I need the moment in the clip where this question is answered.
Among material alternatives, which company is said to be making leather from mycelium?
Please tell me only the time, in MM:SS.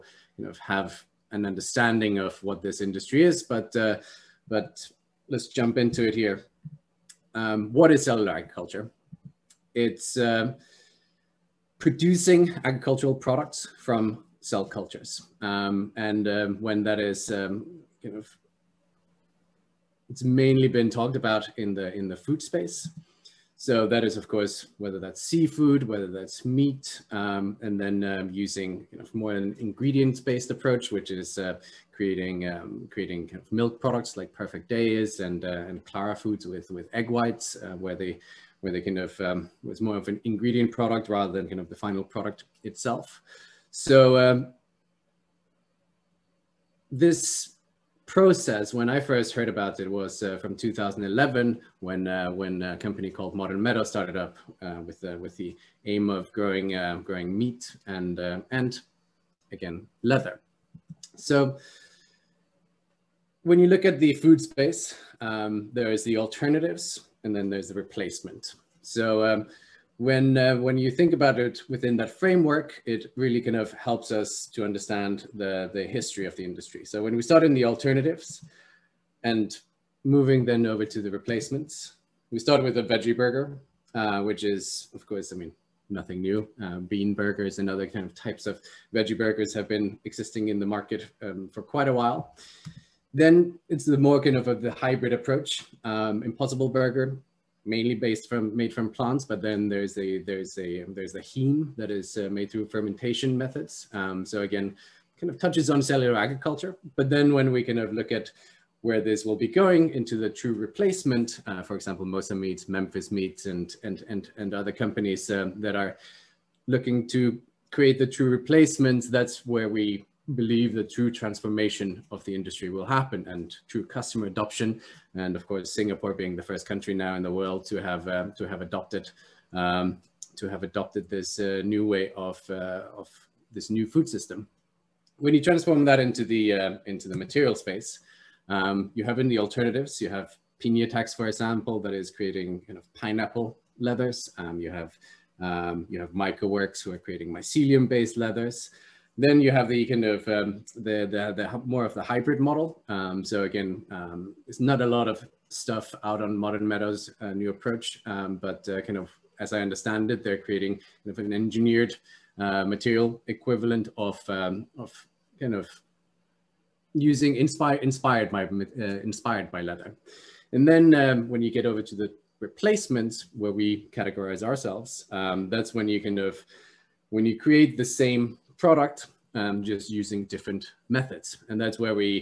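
02:26.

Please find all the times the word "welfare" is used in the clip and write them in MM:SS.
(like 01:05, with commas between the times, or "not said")
not said.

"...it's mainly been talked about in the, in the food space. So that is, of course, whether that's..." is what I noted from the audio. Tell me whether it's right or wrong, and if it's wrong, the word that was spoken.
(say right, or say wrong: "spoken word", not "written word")
right.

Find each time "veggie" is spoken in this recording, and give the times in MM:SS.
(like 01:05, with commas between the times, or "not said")
01:22, 01:28.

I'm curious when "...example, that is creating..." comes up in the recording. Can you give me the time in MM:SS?
02:21.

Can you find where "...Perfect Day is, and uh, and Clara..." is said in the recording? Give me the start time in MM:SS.
00:34.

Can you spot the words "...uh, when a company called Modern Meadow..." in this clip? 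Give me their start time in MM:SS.
00:52.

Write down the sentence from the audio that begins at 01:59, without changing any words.
That's where we believe the true transformation of the industry will happen and true customer adoption.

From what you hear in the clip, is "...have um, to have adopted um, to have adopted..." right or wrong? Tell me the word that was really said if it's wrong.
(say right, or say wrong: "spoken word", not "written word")
right.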